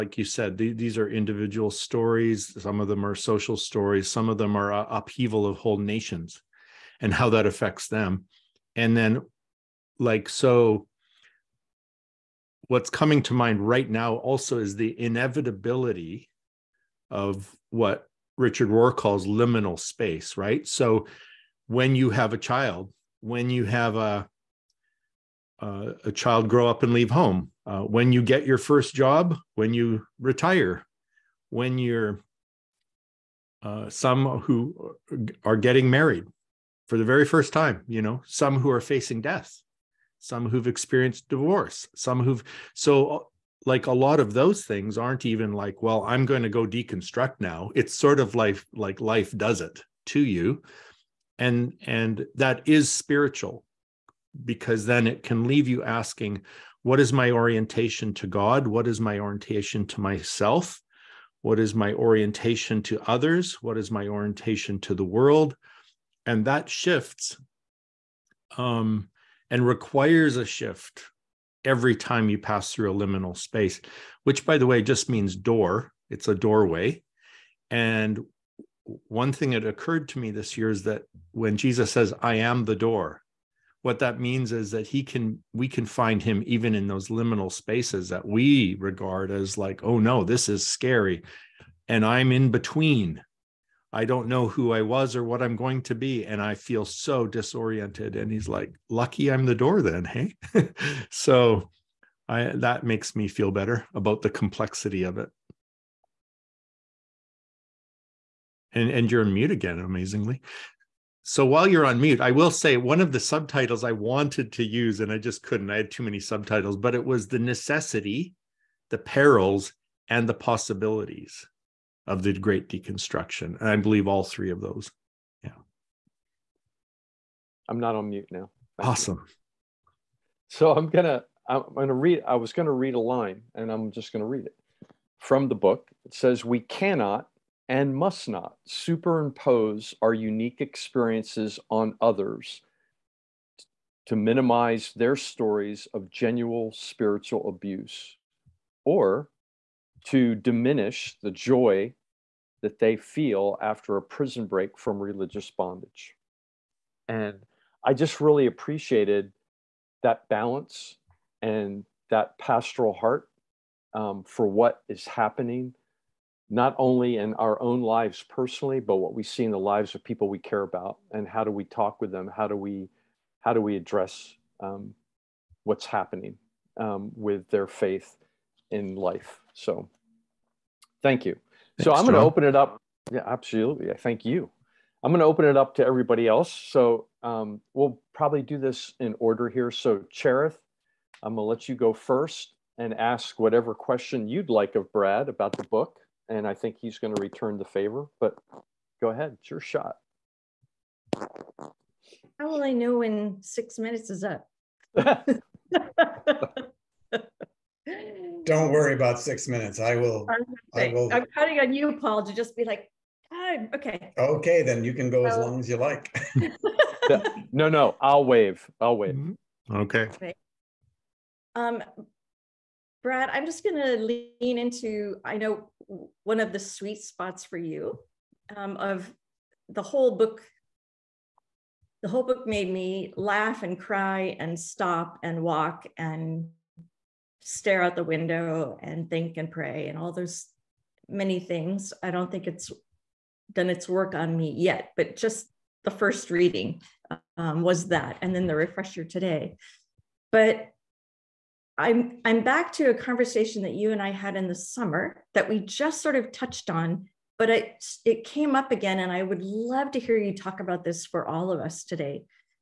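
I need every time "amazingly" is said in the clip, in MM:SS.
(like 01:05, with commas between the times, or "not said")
01:49.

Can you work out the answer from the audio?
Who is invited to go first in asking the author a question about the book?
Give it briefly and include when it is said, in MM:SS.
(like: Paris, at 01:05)
Cherith, at 03:10.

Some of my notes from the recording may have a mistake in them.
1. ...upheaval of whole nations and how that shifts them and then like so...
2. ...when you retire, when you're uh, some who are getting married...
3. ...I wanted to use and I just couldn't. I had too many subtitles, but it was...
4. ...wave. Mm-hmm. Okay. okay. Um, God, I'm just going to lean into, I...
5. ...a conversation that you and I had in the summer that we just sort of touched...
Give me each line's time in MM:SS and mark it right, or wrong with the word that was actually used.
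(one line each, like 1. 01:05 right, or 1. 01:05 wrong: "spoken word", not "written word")
1. 00:04 wrong: "affects", not "shifts"
2. 00:29 right
3. 01:53 right
4. 03:38 wrong: "Brad", not "God"
5. 04:12 right.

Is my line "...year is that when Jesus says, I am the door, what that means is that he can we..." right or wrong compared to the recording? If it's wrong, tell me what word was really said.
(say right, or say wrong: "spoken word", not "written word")
right.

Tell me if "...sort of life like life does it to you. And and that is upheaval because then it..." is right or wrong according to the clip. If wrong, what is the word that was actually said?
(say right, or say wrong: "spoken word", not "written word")
wrong: "spiritual", not "upheaval".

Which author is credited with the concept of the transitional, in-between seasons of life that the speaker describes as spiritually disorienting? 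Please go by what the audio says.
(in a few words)
Richard Rohr.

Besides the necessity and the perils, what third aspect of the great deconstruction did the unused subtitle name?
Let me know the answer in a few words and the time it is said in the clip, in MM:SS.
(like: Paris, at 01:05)
the possibilities, at 02:00.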